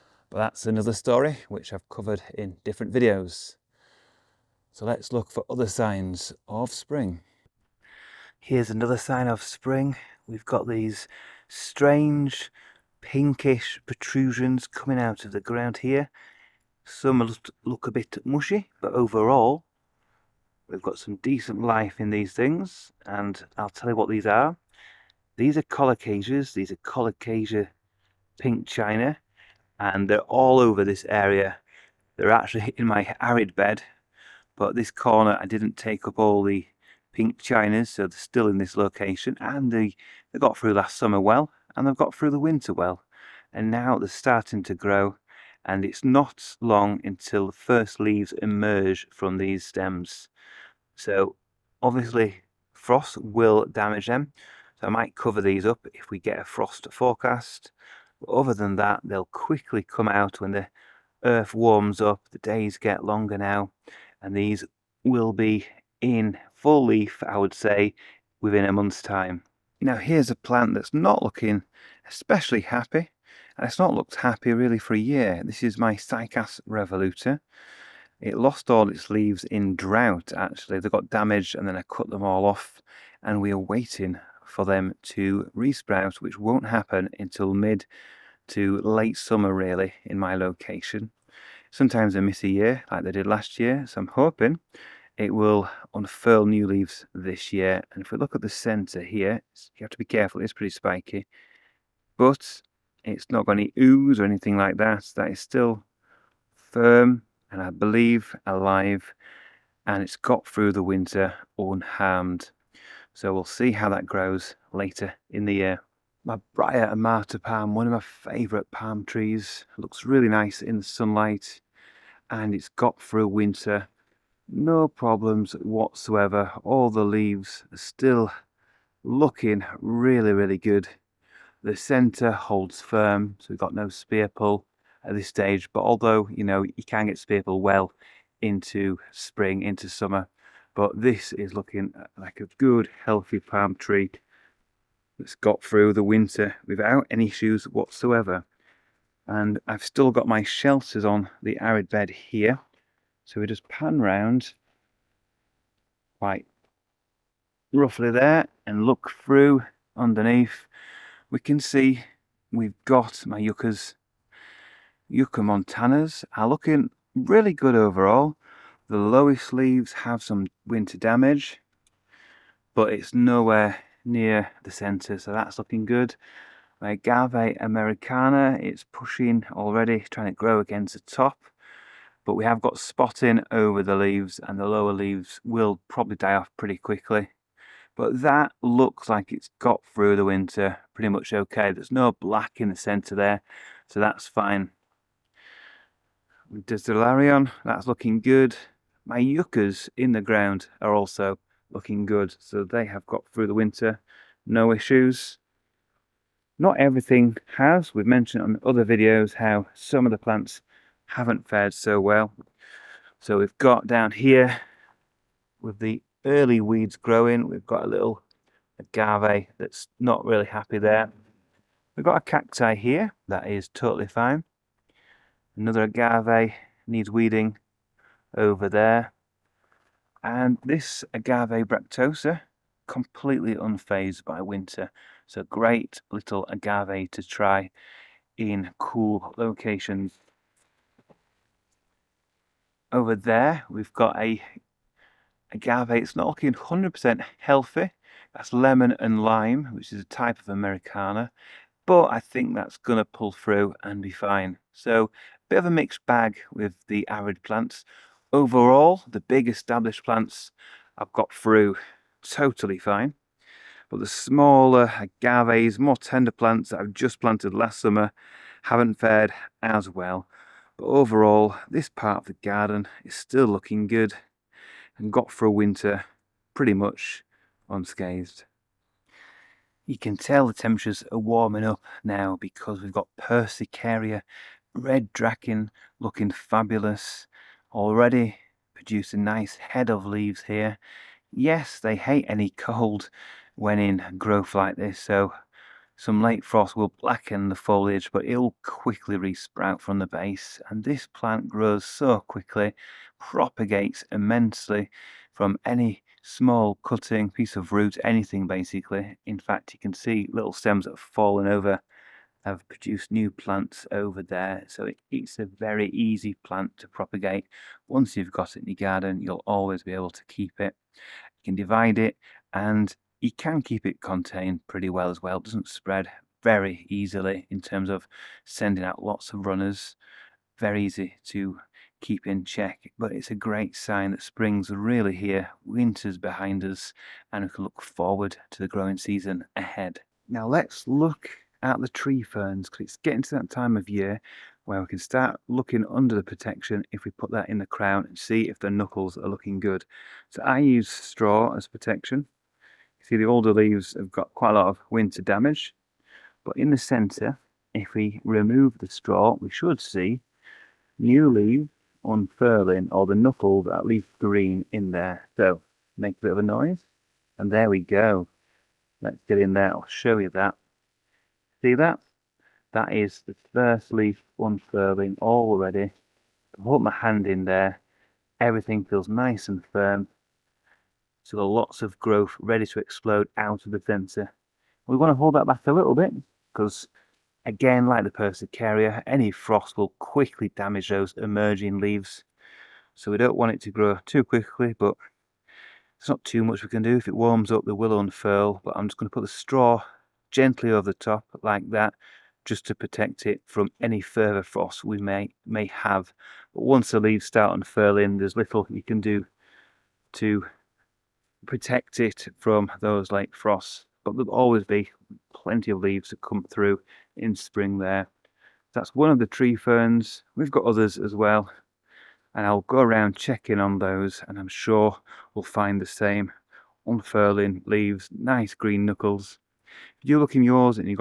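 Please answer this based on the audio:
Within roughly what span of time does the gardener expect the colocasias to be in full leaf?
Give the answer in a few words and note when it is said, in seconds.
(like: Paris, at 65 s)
A month, at 68 s.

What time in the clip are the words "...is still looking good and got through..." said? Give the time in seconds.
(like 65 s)
273 s.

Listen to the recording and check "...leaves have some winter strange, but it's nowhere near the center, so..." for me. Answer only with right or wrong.
wrong.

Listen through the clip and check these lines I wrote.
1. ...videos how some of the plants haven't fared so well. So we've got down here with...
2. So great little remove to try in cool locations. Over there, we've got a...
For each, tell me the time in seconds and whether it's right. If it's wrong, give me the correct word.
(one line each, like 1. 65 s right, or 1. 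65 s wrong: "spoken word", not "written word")
1. 208 s right
2. 235 s wrong: "agave", not "remove".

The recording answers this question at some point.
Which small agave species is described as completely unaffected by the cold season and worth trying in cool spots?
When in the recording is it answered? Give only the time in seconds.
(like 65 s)
231 s.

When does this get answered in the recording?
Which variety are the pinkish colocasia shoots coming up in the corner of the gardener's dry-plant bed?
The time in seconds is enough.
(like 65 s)
28 s.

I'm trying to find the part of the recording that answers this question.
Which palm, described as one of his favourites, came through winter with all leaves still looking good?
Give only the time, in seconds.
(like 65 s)
116 s.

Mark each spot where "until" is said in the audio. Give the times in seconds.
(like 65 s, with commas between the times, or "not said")
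47 s, 87 s.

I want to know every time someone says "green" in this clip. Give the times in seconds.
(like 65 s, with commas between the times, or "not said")
364 s, 428 s.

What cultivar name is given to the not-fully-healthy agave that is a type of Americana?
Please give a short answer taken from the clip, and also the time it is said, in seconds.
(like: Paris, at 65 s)
Lemon and lime, at 248 s.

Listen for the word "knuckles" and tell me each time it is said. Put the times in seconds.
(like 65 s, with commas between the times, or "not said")
348 s, 363 s, 428 s.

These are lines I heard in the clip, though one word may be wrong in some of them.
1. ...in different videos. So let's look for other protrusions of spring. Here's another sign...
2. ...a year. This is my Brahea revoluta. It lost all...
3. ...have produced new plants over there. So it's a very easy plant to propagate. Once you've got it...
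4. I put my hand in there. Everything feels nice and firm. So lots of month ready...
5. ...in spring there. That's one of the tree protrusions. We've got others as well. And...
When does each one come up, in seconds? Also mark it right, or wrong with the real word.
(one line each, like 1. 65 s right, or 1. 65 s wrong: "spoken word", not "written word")
1. 2 s wrong: "signs", not "protrusions"
2. 74 s wrong: "Cycas", not "Brahea"
3. 312 s right
4. 376 s wrong: "growth", not "month"
5. 417 s wrong: "ferns", not "protrusions".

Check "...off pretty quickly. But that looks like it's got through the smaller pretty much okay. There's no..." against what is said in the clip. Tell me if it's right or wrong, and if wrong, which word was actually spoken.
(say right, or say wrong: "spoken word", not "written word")
wrong: "winter", not "smaller".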